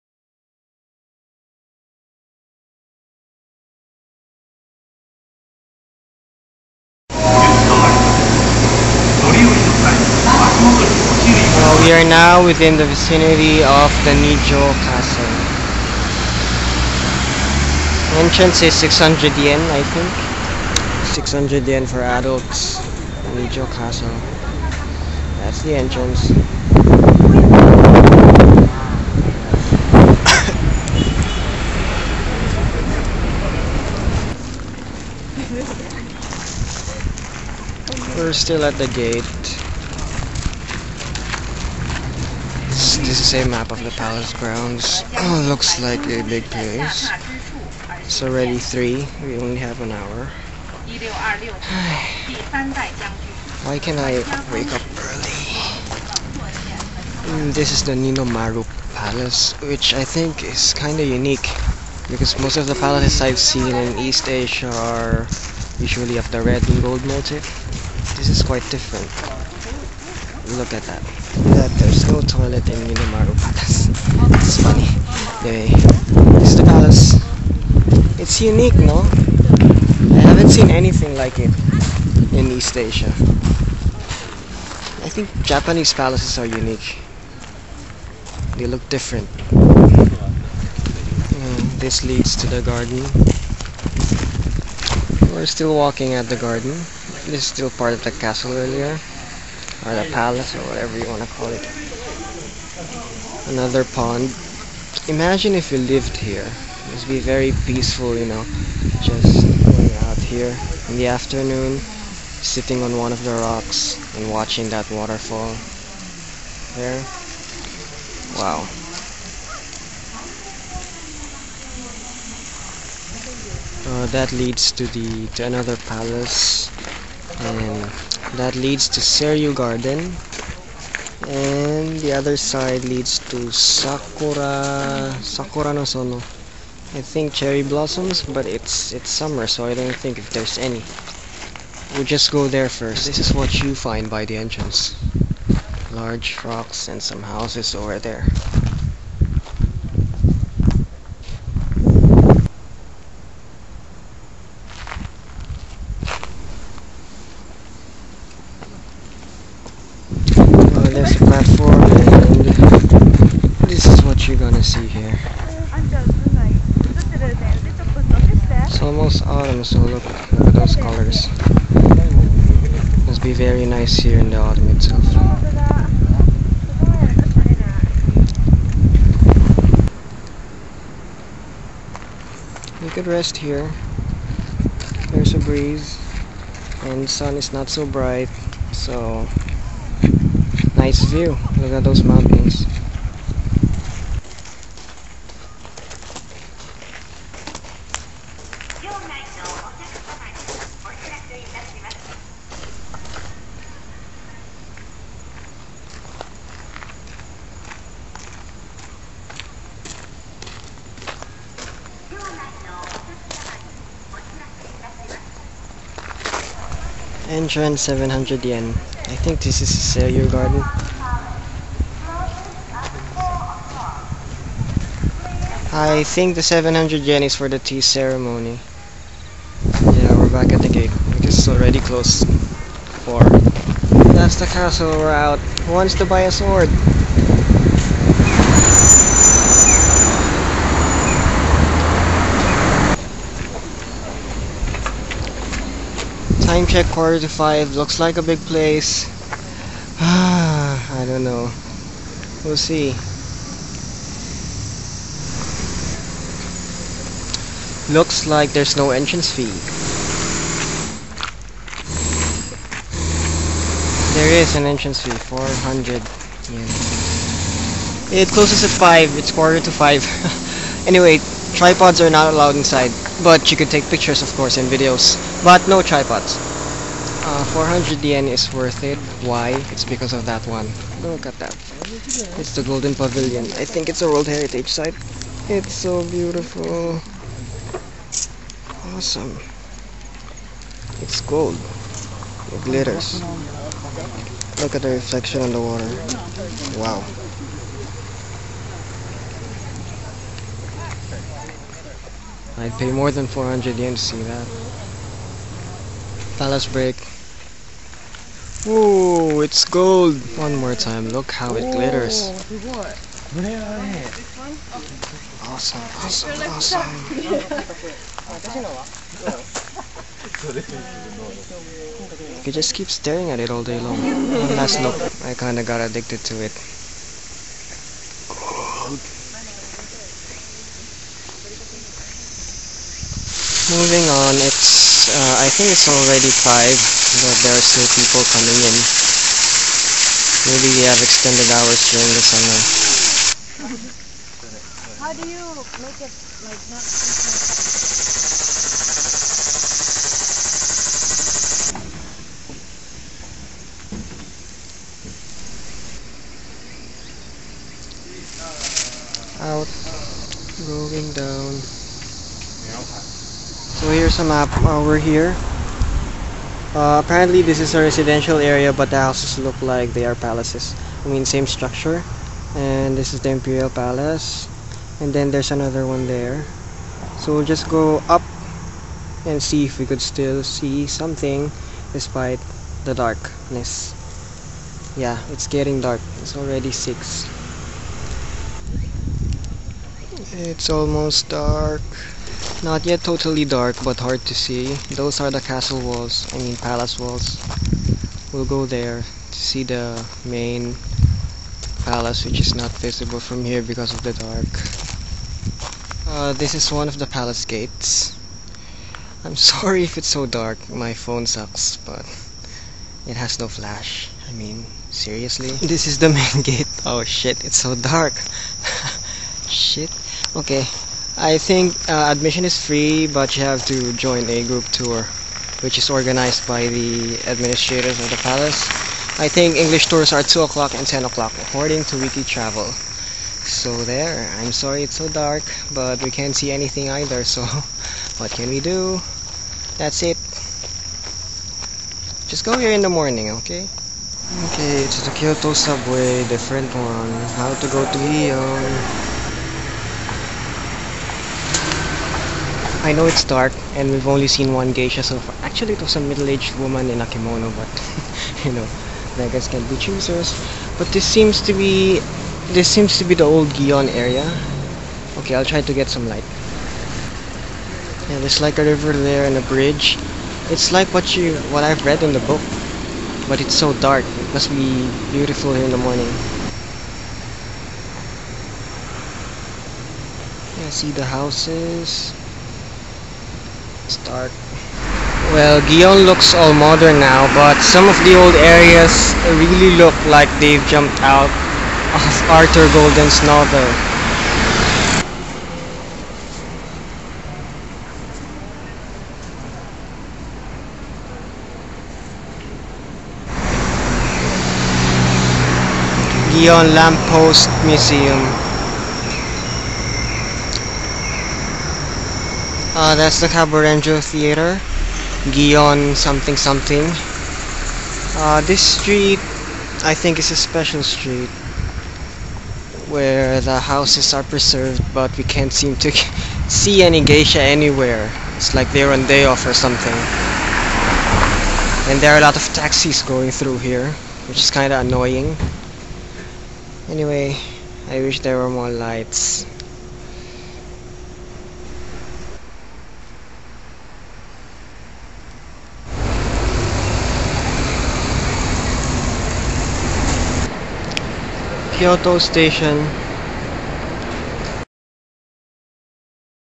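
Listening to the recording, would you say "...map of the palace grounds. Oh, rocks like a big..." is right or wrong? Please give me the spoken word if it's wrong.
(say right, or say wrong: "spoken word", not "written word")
wrong: "looks", not "rocks".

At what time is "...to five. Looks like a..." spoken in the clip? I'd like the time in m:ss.
4:07.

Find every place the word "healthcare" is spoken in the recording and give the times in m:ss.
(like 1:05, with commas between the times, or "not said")
not said.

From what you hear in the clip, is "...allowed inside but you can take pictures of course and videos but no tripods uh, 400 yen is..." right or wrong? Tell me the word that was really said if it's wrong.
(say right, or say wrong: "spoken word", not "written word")
right.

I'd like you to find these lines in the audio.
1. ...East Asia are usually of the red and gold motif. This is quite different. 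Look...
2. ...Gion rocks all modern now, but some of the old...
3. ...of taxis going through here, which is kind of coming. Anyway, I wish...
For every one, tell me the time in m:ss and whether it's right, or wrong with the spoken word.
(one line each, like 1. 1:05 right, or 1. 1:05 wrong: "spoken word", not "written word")
1. 1:03 right
2. 8:05 wrong: "looks", not "rocks"
3. 8:52 wrong: "annoying", not "coming".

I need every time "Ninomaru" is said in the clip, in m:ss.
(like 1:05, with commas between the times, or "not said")
0:57, 1:12.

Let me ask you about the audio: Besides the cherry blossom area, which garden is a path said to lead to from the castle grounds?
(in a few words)
Seiryu Garden.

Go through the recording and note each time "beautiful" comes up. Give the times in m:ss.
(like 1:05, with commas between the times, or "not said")
4:46, 7:55.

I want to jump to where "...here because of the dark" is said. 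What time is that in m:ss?
6:43.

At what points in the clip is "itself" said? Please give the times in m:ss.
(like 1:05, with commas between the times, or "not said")
2:54.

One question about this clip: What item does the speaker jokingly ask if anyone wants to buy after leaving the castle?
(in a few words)
A sword.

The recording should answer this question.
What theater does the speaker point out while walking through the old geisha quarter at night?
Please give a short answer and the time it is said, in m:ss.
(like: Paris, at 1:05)
Kaburenjo Theater, at 8:33.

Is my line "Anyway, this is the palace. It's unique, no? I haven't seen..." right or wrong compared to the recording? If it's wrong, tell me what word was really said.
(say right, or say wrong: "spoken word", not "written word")
right.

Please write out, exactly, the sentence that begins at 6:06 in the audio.
Uh, apparently this is a residential area but the houses look like they are palaces.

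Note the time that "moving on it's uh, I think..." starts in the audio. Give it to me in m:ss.
5:33.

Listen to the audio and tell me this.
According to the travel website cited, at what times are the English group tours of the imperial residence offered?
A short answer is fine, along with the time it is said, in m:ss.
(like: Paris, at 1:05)
2 o'clock and 10 o'clock, at 7:10.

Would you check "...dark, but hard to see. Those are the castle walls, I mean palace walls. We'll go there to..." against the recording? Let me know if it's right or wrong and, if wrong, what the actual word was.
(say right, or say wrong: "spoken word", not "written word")
right.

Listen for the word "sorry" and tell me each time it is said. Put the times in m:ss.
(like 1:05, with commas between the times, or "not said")
6:49, 7:14.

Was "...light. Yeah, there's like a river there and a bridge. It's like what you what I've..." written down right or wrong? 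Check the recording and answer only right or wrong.
right.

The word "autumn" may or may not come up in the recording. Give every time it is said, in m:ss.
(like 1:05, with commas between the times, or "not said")
2:49, 2:54.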